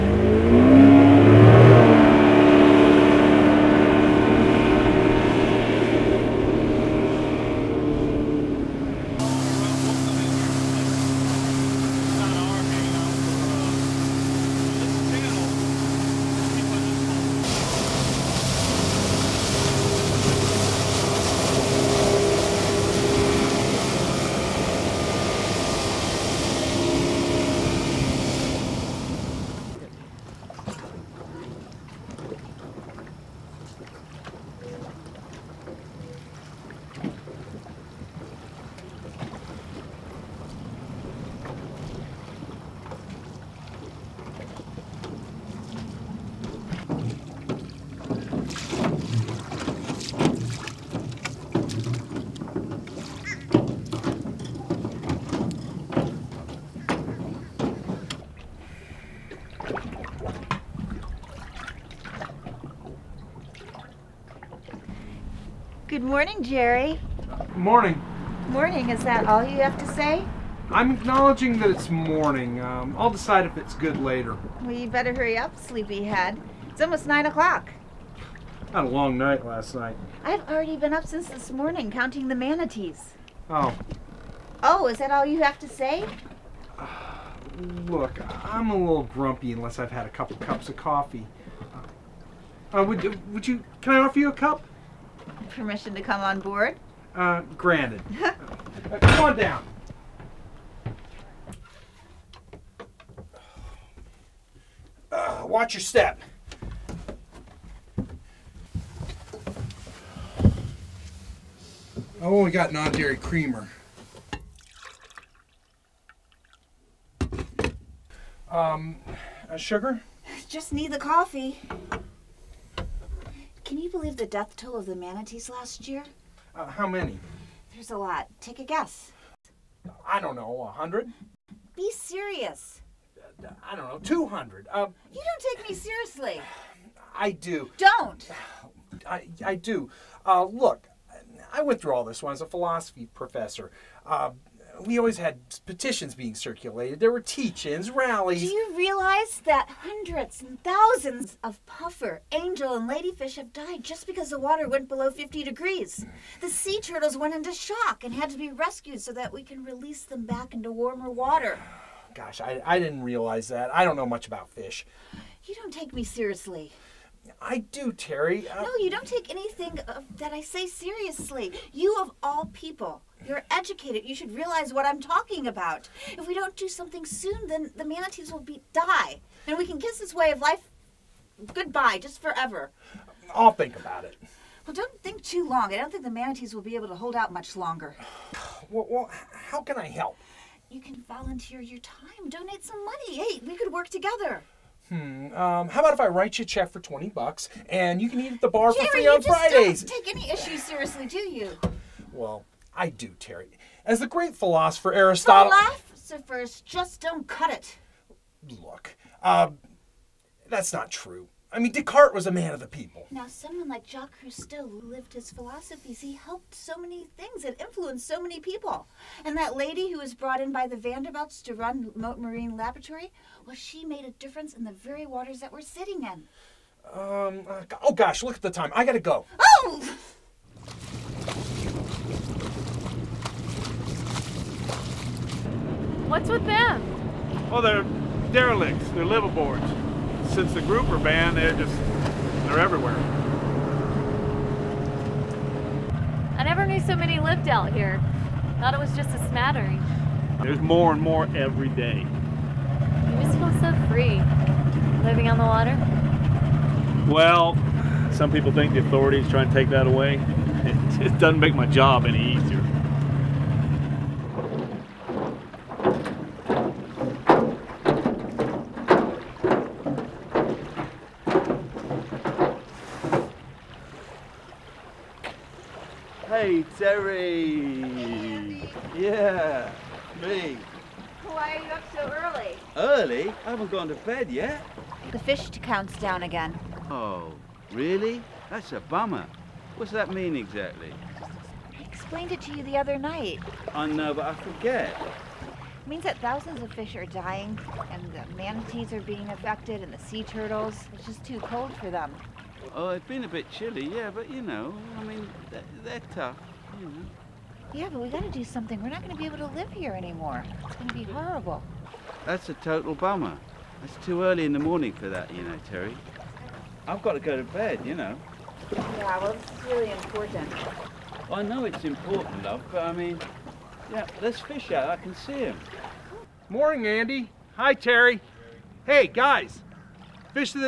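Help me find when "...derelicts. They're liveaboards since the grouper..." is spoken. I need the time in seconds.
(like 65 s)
238 s.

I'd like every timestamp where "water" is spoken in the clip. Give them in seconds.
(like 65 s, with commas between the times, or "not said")
154 s, 161 s, 225 s, 255 s.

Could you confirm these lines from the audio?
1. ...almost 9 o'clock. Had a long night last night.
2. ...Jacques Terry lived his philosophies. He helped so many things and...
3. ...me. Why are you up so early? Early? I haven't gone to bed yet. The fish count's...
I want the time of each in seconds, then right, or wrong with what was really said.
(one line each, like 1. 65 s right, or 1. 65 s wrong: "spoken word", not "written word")
1. 76 s right
2. 213 s wrong: "Cousteau", not "Terry"
3. 280 s right.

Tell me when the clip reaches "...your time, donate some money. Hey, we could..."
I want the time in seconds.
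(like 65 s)
191 s.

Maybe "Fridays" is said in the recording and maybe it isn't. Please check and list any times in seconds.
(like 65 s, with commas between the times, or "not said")
199 s.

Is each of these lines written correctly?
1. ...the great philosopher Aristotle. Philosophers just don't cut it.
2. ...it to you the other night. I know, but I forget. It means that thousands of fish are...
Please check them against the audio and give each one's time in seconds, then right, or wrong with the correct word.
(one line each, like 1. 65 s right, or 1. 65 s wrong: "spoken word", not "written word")
1. 203 s right
2. 292 s right.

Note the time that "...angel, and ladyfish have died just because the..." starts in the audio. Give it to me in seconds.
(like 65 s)
152 s.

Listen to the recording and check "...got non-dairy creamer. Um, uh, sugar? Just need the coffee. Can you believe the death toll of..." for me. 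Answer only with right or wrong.
right.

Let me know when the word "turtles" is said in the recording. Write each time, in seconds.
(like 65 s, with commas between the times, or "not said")
156 s, 300 s.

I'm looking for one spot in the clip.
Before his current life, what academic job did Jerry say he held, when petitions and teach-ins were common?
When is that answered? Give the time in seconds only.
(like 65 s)
142 s.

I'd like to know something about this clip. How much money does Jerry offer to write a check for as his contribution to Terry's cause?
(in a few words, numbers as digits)
$20.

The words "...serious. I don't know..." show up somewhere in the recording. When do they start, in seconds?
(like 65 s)
131 s.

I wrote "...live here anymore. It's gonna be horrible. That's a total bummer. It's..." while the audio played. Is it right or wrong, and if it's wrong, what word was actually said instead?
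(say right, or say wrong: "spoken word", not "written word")
right.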